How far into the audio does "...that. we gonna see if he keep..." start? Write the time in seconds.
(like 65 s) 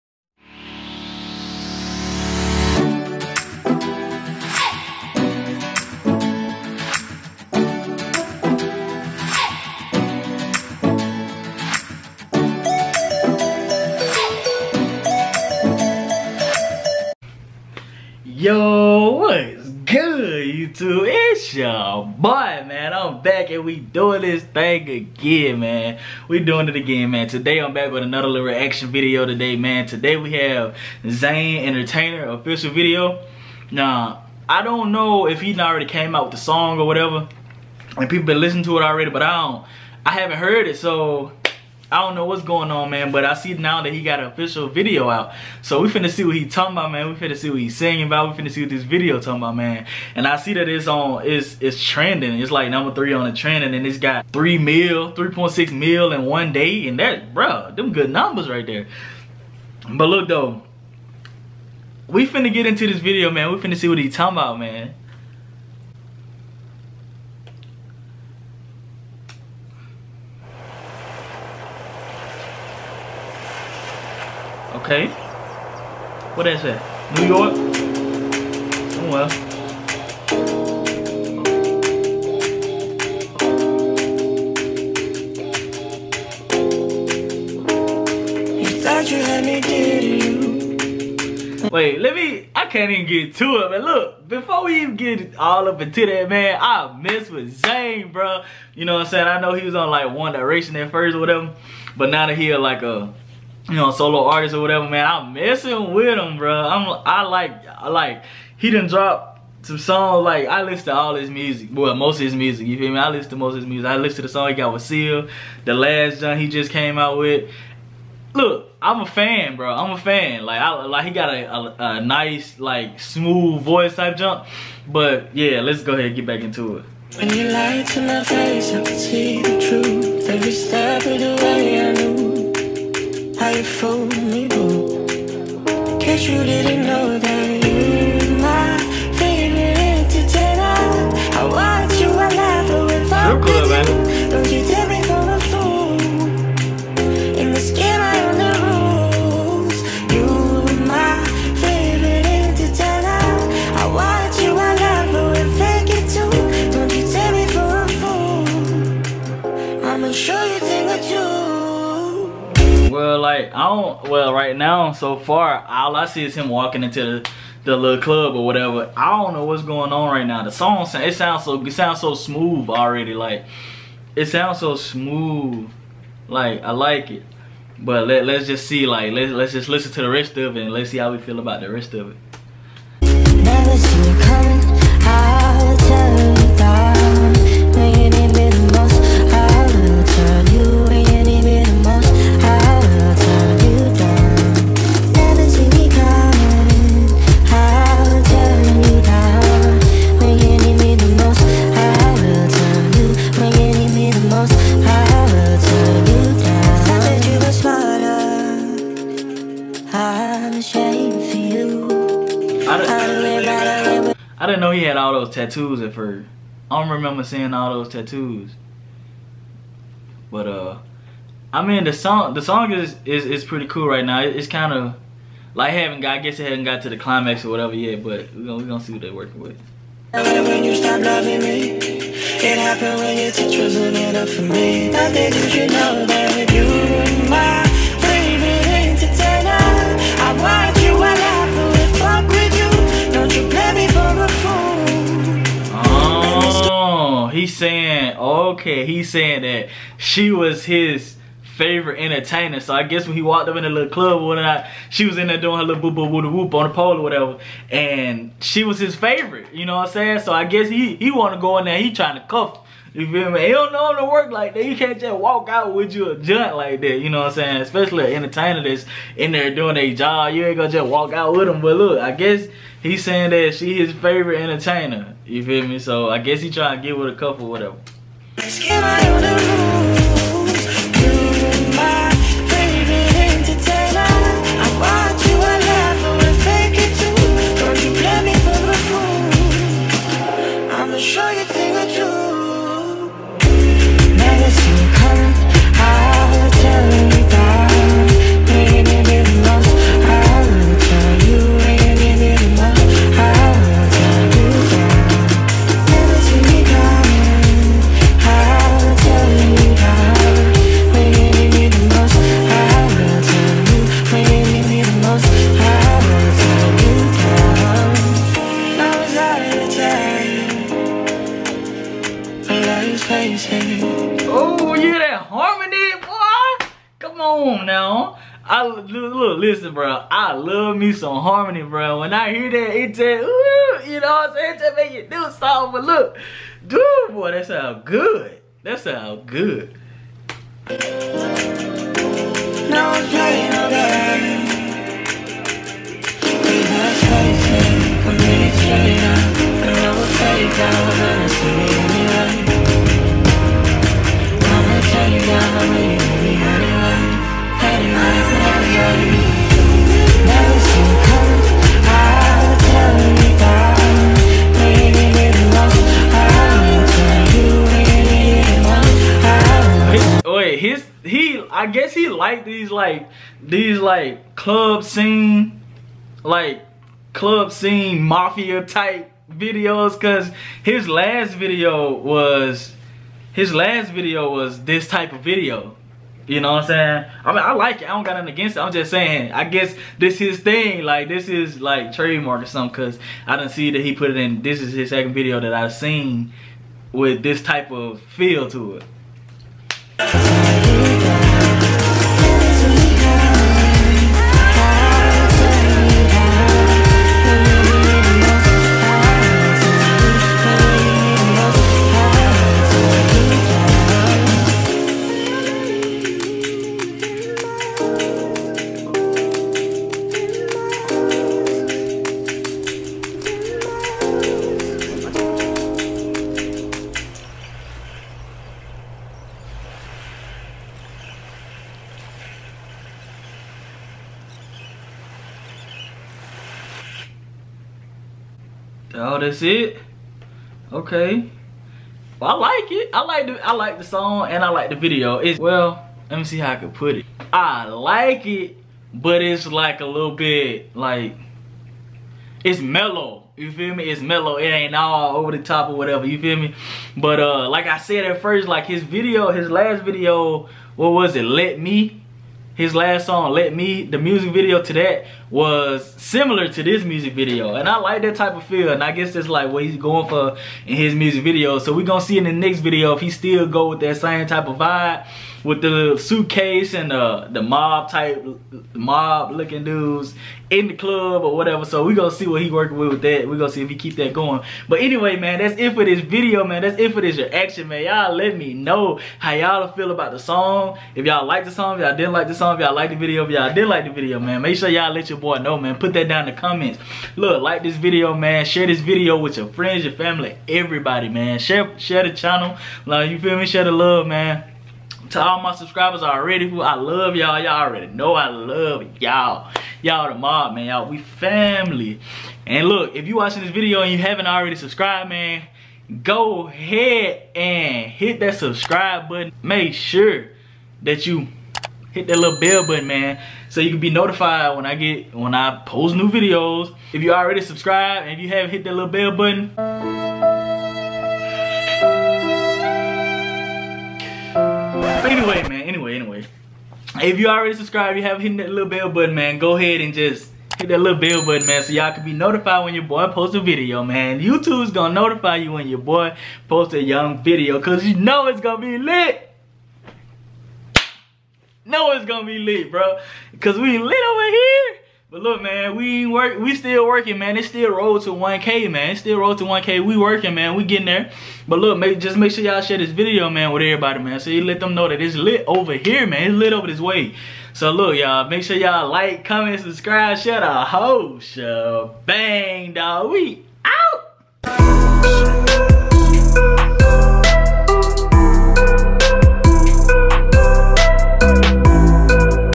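483 s.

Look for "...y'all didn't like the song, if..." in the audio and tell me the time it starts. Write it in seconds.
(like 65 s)
491 s.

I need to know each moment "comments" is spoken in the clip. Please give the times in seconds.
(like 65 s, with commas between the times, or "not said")
496 s, 569 s.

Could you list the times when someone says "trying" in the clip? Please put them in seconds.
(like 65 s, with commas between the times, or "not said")
261 s, 276 s.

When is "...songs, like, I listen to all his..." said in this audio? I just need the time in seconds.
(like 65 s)
109 s.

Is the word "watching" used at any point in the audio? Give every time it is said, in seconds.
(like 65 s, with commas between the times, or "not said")
513 s.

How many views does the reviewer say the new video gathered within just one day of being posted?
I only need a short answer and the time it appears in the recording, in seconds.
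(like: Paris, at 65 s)
3.6 million, at 55 s.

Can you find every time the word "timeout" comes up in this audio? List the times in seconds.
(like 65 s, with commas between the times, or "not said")
not said.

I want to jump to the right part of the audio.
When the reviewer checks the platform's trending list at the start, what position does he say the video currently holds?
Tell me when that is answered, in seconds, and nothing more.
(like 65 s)
52 s.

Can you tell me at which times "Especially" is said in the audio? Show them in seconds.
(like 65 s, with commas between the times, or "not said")
267 s.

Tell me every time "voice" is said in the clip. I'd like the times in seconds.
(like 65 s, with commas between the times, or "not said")
123 s.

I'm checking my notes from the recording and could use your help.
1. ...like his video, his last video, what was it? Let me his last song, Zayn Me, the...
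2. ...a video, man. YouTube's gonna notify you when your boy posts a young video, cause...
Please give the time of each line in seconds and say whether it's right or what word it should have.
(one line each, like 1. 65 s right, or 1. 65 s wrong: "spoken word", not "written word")
1. 458 s wrong: "Let", not "Zayn"
2. 543 s right.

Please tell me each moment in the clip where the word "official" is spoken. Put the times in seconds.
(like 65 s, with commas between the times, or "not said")
32 s, 44 s.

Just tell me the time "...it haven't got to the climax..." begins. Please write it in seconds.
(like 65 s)
226 s.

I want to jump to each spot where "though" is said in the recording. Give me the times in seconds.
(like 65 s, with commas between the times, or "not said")
60 s.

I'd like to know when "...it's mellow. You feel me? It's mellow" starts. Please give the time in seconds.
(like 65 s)
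452 s.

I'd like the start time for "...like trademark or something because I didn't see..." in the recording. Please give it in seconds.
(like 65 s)
391 s.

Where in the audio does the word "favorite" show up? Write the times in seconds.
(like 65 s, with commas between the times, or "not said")
251 s, 258 s, 273 s.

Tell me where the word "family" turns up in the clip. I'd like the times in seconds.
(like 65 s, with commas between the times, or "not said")
499 s, 510 s.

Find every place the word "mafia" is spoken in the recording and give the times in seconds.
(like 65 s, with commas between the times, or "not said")
378 s.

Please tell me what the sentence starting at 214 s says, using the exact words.
had all those tattoos at first.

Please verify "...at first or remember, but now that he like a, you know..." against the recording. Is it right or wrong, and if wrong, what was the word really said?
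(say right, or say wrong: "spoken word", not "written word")
wrong: "whatever", not "remember".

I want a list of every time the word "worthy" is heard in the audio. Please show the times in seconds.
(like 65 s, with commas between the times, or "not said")
not said.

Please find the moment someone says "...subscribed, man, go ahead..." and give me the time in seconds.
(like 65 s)
514 s.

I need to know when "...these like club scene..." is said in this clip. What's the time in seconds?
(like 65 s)
373 s.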